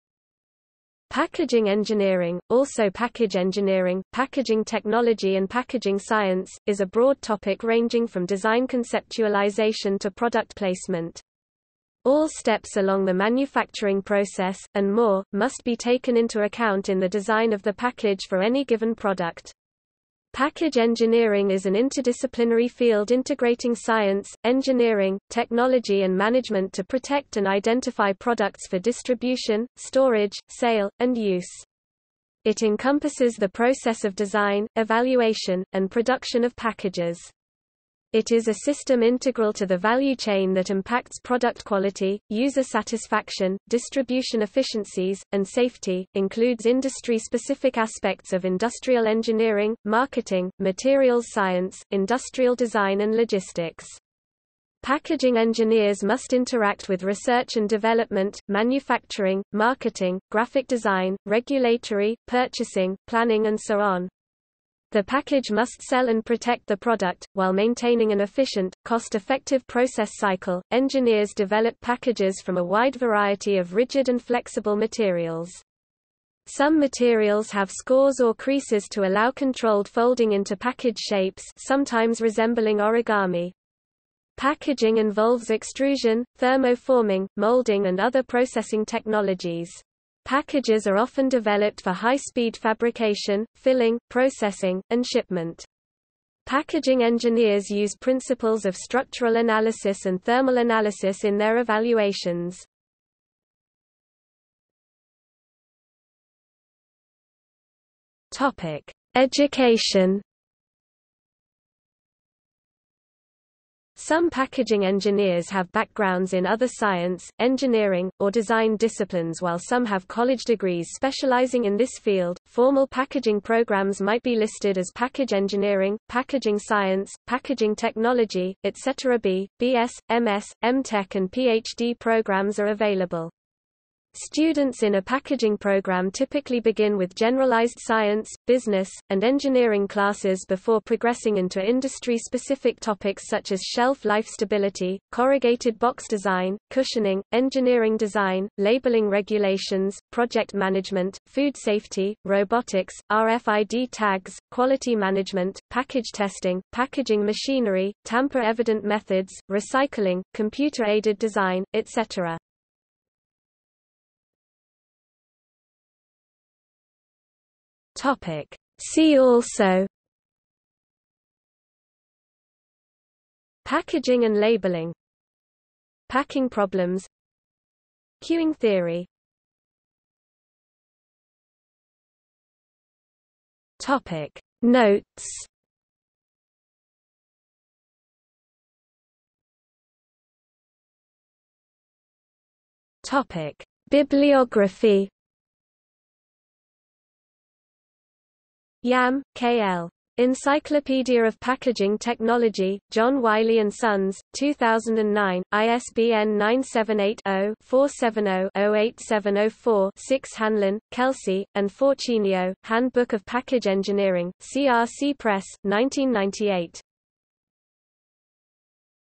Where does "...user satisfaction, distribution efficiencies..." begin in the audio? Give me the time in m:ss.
0:42.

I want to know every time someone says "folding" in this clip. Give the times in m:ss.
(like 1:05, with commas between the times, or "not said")
1:19.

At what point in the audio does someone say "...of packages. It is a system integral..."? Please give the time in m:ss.
0:36.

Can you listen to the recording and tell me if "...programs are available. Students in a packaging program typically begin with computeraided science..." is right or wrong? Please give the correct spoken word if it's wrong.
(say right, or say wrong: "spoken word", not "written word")
wrong: "generalized", not "computeraided".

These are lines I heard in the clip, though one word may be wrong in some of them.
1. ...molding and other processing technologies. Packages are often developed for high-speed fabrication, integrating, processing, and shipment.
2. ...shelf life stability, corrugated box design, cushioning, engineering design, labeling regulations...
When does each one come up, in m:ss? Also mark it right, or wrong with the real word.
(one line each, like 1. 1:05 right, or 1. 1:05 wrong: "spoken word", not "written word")
1. 1:27 wrong: "filling", not "integrating"
2. 2:23 right.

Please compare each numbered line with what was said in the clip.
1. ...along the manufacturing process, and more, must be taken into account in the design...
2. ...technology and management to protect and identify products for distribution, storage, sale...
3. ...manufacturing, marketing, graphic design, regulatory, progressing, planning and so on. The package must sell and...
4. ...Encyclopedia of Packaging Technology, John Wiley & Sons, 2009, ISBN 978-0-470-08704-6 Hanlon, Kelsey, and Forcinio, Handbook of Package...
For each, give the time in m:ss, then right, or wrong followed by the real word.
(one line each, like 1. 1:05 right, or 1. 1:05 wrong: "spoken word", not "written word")
1. 0:12 right
2. 0:25 right
3. 0:58 wrong: "purchasing", not "progressing"
4. 3:20 right.